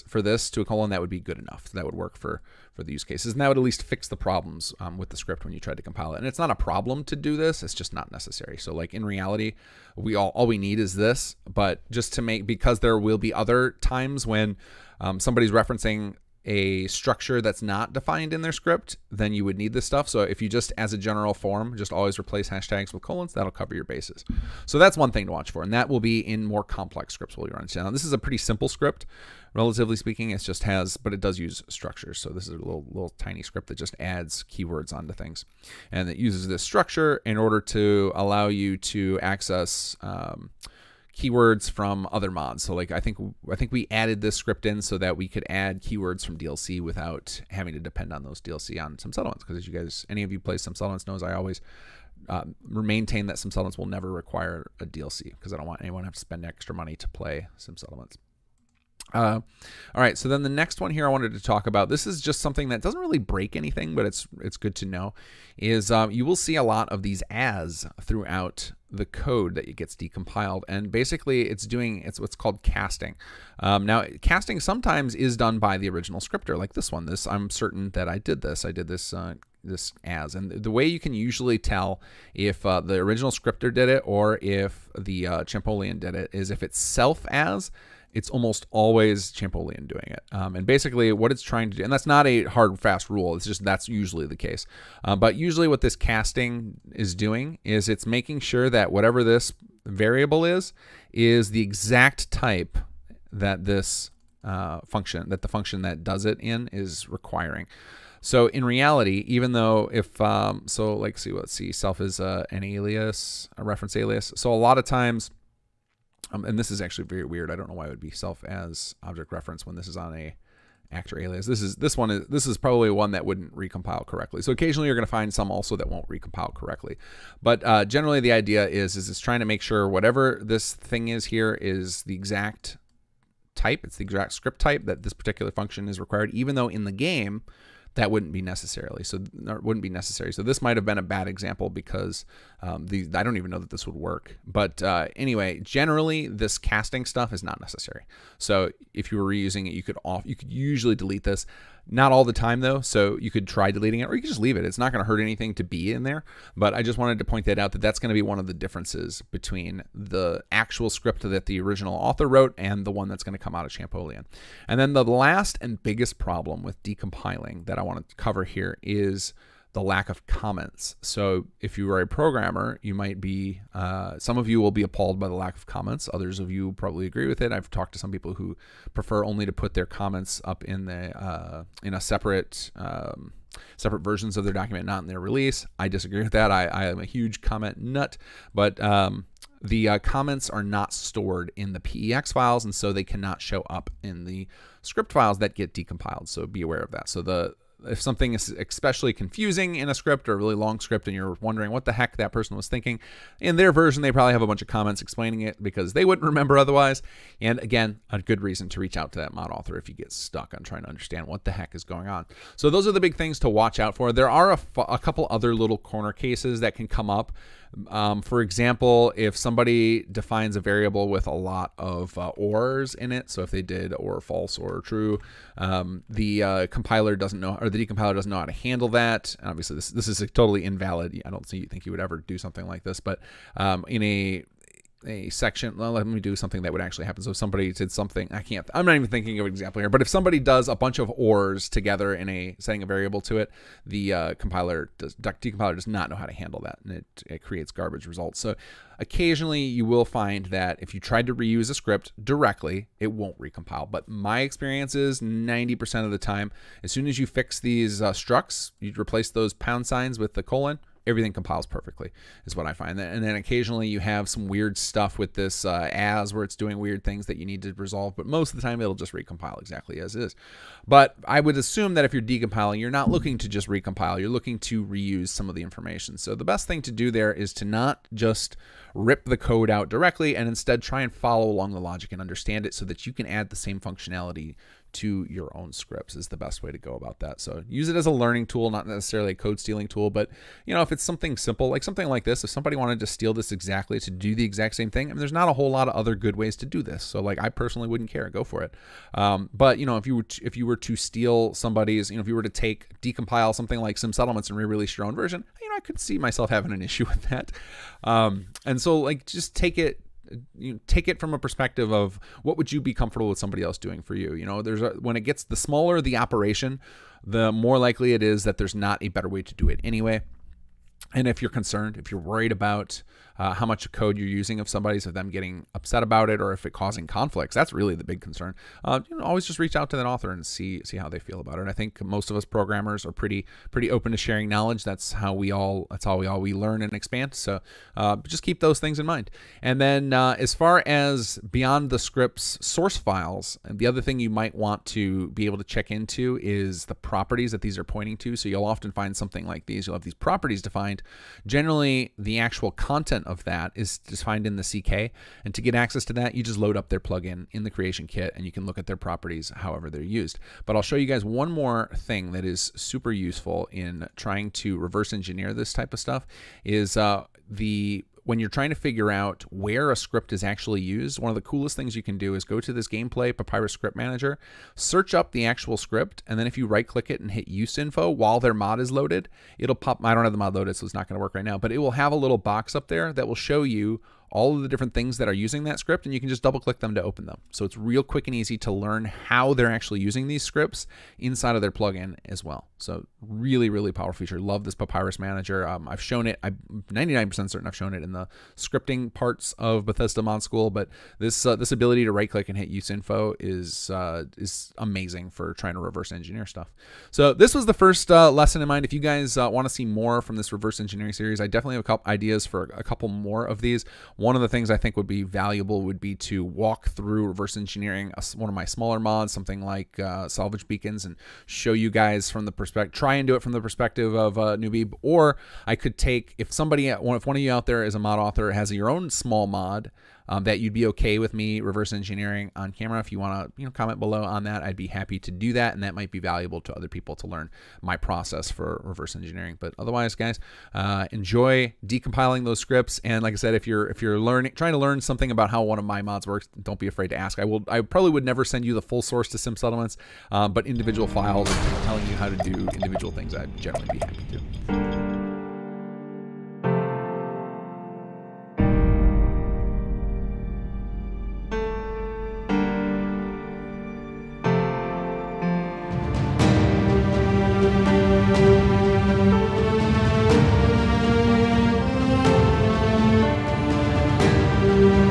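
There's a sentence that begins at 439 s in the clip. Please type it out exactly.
But otherwise, guys, uh, enjoy decompiling those scripts.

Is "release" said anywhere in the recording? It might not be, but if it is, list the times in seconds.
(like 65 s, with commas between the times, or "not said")
185 s, 304 s.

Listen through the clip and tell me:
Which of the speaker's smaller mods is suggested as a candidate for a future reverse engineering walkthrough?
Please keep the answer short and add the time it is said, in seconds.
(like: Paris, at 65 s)
Salvage Beacons, at 420 s.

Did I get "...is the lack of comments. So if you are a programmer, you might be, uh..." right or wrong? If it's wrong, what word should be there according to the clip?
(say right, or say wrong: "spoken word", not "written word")
right.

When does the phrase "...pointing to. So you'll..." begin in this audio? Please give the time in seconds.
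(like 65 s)
347 s.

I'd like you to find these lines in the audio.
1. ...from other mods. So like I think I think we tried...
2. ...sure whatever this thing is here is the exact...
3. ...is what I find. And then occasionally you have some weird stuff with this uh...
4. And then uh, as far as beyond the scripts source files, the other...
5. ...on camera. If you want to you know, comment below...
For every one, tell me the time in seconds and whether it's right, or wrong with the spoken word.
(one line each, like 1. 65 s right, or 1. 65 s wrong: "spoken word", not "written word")
1. 41 s wrong: "added", not "tried"
2. 129 s right
3. 262 s right
4. 339 s right
5. 432 s right.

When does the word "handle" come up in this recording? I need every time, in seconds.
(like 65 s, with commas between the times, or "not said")
228 s, 246 s.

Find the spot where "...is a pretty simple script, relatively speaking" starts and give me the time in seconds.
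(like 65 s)
28 s.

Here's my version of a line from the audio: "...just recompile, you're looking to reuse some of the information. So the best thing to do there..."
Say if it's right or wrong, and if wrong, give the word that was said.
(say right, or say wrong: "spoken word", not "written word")
right.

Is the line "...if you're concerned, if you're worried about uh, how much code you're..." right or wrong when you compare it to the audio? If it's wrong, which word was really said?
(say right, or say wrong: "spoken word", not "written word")
right.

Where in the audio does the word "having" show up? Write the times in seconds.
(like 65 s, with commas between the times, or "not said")
47 s, 306 s.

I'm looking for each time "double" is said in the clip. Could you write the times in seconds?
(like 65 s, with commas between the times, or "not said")
386 s.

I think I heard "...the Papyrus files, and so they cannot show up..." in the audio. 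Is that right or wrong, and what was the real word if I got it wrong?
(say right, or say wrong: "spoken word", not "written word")
wrong: "PEX", not "Papyrus".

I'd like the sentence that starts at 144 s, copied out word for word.
But uh, anyway, generally this casting stuff is not necessary.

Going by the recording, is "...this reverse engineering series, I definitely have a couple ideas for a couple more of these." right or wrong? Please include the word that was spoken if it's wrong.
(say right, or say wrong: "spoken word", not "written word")
right.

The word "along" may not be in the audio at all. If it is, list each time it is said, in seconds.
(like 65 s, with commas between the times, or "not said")
281 s.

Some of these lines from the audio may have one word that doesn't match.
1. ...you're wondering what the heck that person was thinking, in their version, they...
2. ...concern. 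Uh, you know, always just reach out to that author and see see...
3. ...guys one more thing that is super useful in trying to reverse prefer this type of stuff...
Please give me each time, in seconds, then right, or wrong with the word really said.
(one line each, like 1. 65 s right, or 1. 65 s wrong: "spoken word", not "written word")
1. 201 s right
2. 328 s right
3. 361 s wrong: "engineer", not "prefer".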